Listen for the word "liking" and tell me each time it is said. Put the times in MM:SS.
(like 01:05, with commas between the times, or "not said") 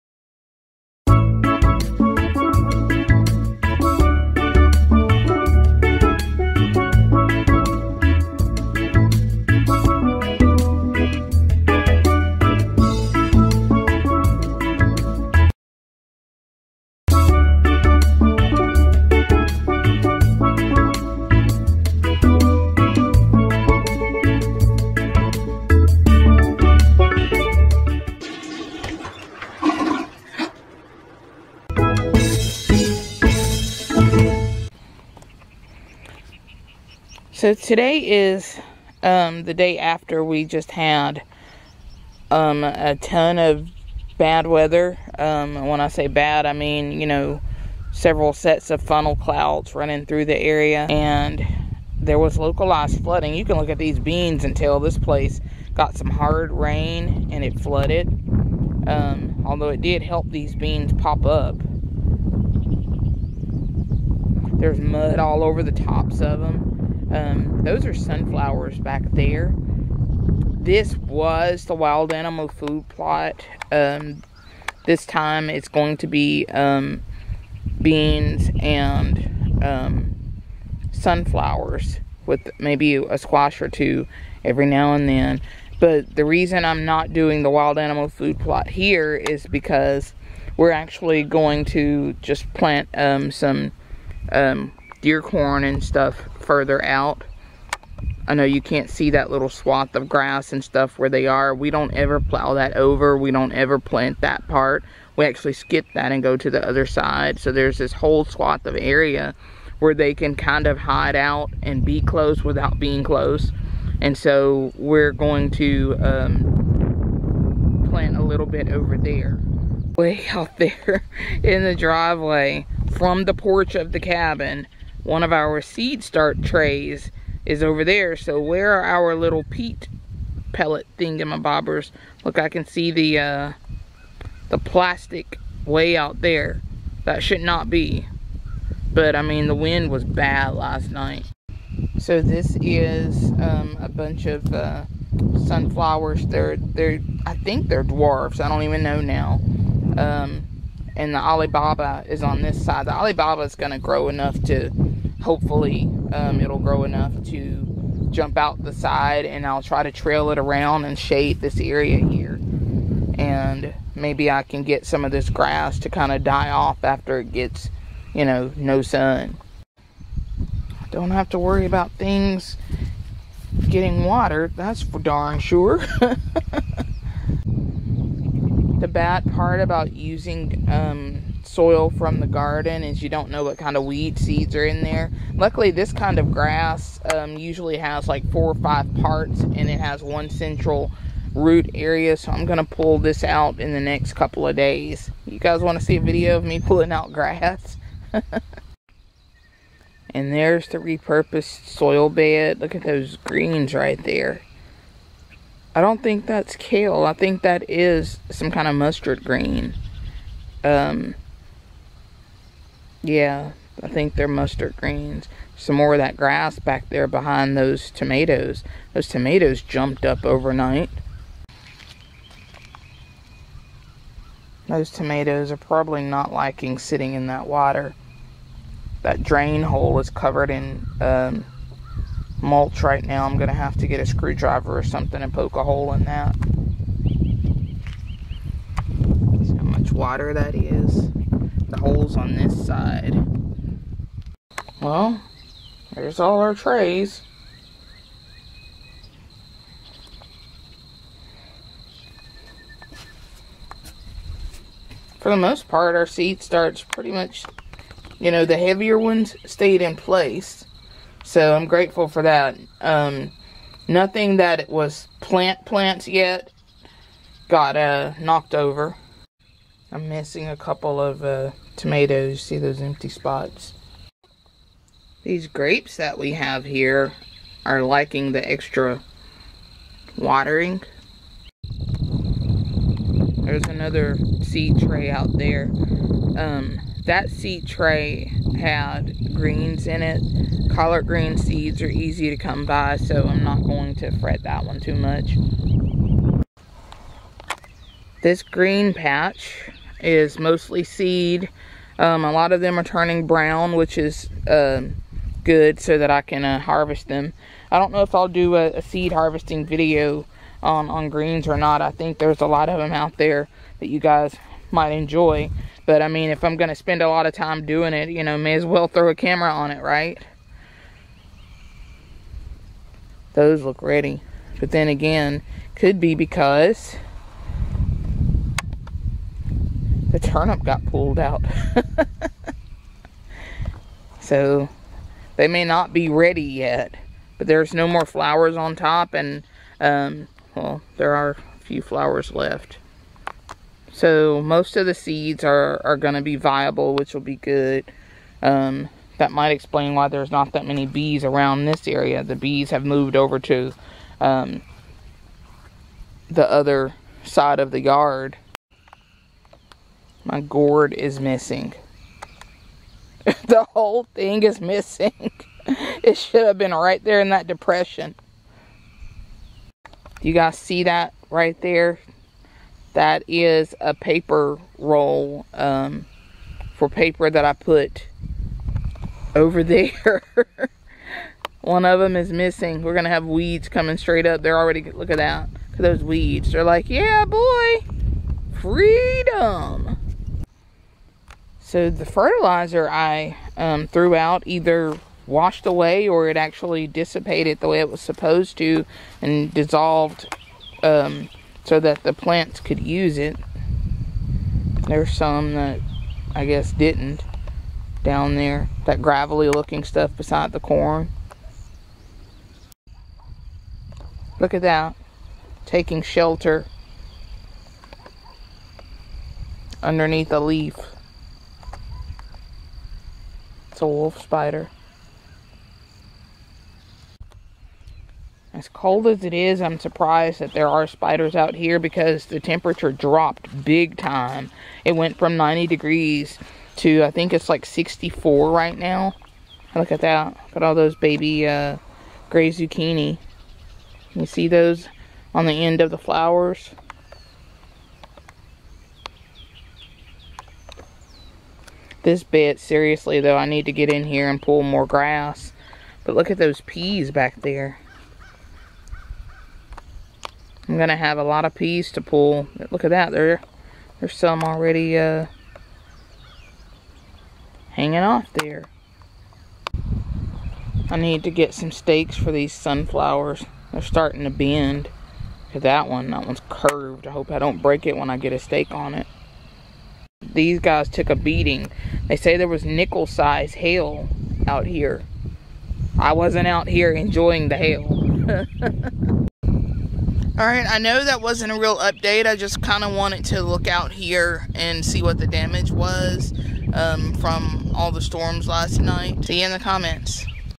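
03:46, 04:37.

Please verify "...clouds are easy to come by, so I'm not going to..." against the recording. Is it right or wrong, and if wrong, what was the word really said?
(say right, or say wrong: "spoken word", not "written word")
wrong: "seeds", not "clouds".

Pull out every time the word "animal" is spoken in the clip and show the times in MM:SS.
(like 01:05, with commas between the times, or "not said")
01:12, 01:27.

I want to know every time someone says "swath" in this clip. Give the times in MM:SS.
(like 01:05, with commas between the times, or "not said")
01:39, 01:48.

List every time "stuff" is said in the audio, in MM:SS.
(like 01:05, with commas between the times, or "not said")
01:35, 01:40, 06:49.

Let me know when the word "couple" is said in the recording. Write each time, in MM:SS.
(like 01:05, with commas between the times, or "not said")
03:14, 04:30.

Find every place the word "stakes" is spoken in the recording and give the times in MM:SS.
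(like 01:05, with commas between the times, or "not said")
07:51, 07:58.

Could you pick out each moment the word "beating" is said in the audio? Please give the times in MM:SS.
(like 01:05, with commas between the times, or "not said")
08:01.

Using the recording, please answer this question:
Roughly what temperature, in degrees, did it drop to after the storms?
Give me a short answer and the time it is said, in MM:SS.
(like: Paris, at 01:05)
64, at 07:17.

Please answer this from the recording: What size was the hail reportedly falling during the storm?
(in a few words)
nickel size.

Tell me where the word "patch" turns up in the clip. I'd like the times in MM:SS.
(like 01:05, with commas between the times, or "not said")
04:58.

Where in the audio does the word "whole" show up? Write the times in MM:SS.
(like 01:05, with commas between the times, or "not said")
01:47, 06:03.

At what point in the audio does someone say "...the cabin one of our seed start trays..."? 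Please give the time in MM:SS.
02:03.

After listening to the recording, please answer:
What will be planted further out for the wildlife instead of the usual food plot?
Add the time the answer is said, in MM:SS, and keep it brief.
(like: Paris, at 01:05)
deer corn, at 01:35.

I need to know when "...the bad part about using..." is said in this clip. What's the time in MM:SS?
02:58.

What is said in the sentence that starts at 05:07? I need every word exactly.
I don't know if I'll do a, a seed harvesting video on, on greens or not.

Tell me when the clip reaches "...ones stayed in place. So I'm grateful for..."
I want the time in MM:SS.
04:18.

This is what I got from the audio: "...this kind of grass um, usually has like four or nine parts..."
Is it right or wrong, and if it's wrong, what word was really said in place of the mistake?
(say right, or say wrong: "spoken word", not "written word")
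wrong: "five", not "nine".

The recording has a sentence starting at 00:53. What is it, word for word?
You can look at these beans and tell this place got some hard rain and it flooded.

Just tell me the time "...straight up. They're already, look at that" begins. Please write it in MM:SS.
06:23.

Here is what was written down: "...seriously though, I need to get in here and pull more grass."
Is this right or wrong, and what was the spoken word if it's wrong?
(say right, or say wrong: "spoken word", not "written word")
right.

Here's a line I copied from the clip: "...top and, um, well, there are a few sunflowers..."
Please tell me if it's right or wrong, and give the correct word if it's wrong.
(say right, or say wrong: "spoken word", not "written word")
wrong: "flowers", not "sunflowers".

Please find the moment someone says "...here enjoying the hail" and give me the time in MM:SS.
08:06.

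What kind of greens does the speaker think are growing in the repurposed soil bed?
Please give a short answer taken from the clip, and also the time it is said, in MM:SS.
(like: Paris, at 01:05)
mustard greens, at 03:34.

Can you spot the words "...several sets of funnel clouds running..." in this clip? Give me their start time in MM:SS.
00:47.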